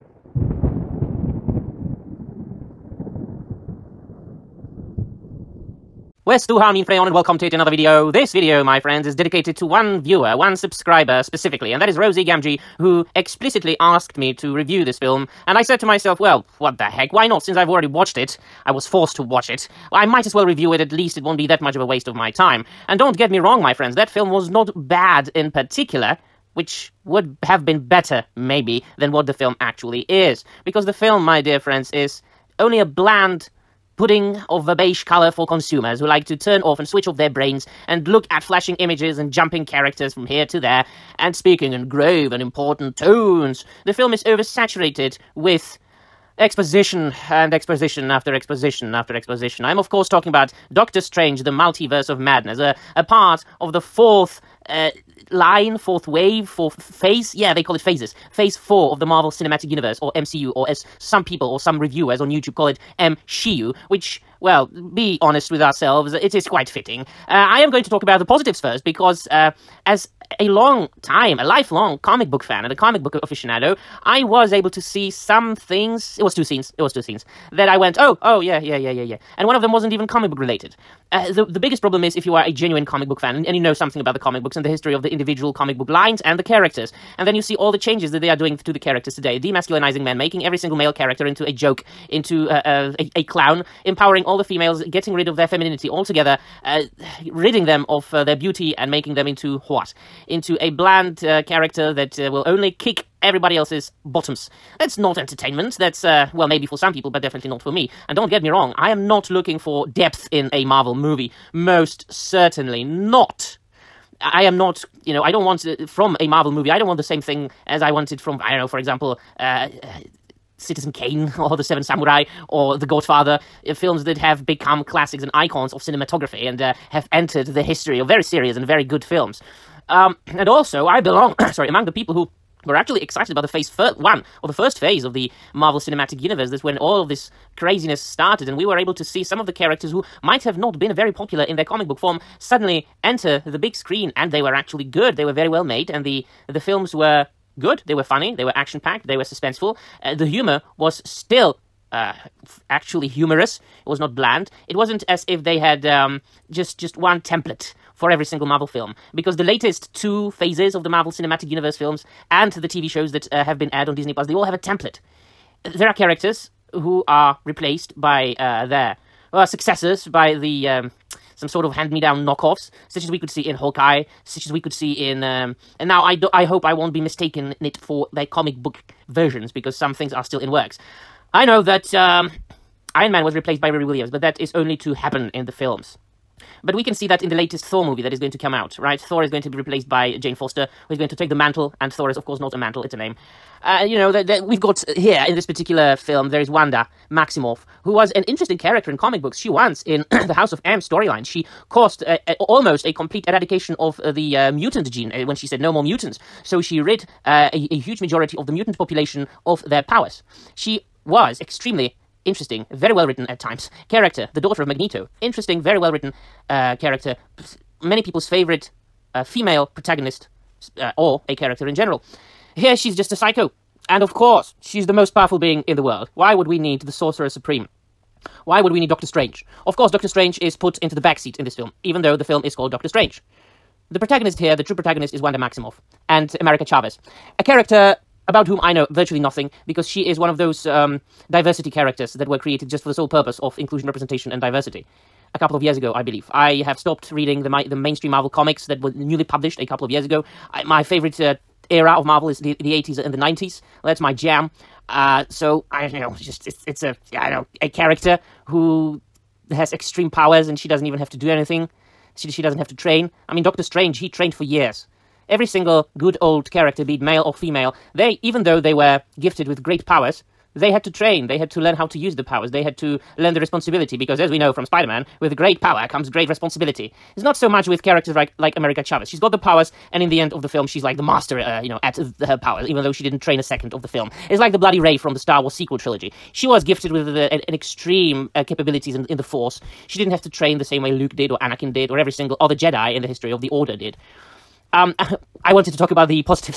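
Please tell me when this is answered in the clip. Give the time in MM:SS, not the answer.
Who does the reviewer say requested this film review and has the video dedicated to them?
00:11.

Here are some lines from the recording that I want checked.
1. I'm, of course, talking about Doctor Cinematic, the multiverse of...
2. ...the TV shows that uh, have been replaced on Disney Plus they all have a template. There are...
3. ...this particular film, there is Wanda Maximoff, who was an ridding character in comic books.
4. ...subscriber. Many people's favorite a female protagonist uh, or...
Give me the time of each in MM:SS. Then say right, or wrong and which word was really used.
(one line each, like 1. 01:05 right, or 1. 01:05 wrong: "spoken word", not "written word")
1. 00:49 wrong: "Strange", not "Cinematic"
2. 02:42 wrong: "aired", not "replaced"
3. 03:15 wrong: "interesting", not "ridding"
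4. 03:36 wrong: "character", not "subscriber".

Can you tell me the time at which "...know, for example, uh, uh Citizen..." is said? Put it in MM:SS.
01:58.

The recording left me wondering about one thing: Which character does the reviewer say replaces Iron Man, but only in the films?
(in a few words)
Riri Williams.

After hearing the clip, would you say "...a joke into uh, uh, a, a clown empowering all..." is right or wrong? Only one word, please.
right.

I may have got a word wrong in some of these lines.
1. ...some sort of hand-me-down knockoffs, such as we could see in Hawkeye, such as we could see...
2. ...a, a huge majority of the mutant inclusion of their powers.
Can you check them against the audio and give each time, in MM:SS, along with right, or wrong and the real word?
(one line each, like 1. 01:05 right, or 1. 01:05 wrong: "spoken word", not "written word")
1. 02:51 right
2. 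03:27 wrong: "population", not "inclusion".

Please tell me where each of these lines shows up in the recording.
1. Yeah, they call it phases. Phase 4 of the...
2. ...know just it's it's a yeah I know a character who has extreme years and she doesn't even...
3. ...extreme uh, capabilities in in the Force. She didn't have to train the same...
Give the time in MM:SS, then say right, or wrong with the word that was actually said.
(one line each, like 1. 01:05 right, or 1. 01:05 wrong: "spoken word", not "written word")
1. 00:57 right
2. 04:15 wrong: "powers", not "years"
3. 04:47 right.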